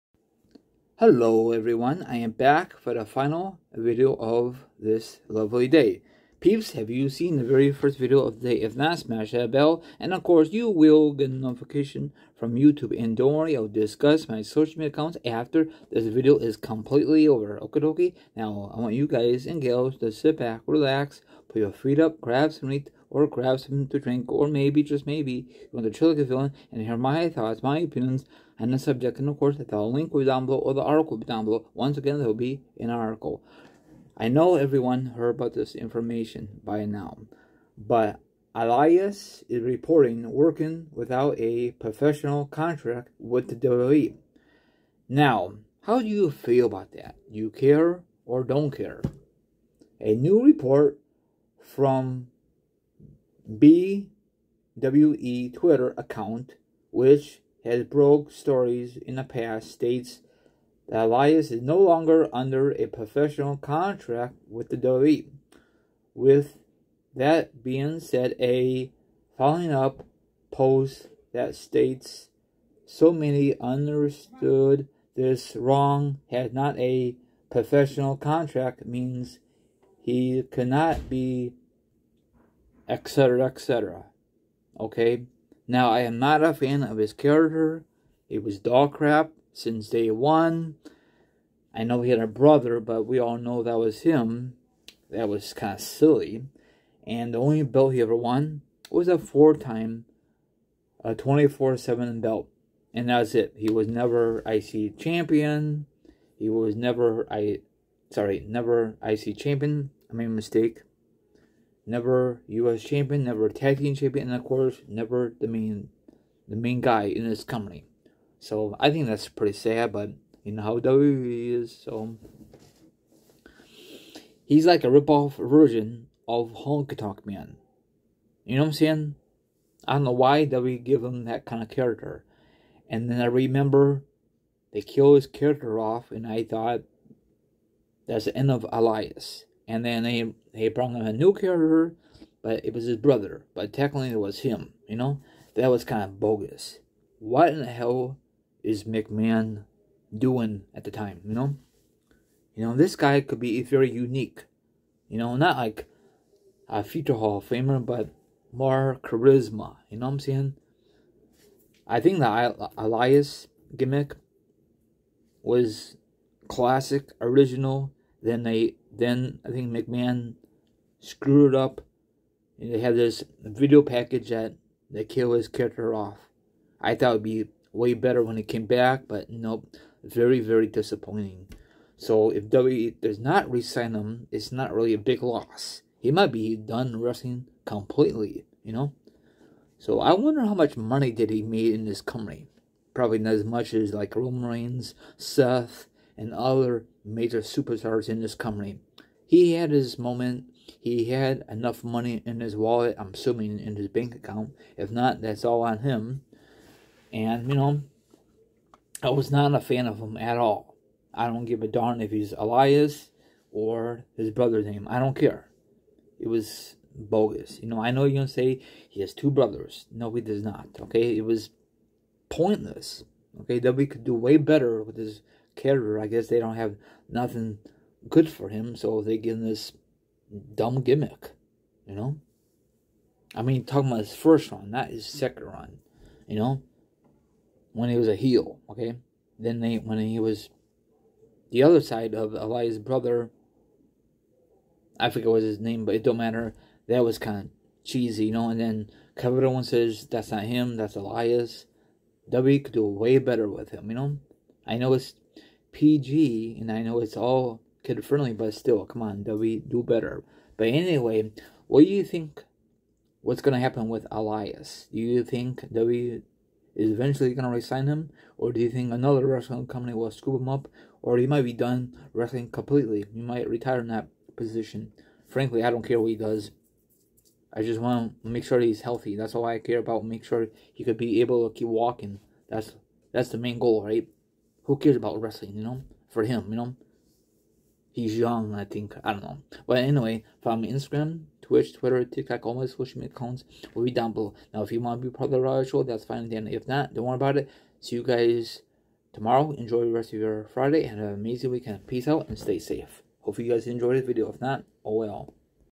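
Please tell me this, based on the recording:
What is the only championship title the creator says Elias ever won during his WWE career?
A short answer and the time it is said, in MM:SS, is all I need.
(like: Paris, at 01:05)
24/7 belt, at 01:41.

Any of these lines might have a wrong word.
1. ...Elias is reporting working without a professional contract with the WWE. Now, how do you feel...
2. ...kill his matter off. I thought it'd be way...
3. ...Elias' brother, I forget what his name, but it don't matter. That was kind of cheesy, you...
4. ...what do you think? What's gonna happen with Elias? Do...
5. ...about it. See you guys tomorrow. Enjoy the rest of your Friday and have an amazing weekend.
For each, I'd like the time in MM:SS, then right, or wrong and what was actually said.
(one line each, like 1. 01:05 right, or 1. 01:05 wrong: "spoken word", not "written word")
1. 00:38 right
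2. 02:55 wrong: "character", not "matter"
3. 04:02 right
4. 04:21 right
5. 04:57 right.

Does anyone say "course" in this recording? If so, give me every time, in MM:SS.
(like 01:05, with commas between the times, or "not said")
00:10, 00:29, 01:54.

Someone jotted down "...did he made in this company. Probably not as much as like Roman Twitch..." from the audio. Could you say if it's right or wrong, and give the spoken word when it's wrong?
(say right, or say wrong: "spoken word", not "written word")
wrong: "Reigns", not "Twitch".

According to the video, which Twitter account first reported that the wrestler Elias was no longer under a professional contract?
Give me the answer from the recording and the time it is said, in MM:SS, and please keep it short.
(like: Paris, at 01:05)
BWE, at 00:53.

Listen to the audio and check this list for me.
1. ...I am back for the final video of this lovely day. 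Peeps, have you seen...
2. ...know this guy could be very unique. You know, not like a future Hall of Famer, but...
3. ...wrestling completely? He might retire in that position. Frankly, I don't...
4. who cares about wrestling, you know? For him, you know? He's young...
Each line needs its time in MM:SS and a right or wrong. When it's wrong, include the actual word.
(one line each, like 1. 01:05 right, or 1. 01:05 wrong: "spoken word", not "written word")
1. 00:02 right
2. 02:32 right
3. 04:32 right
4. 04:44 right.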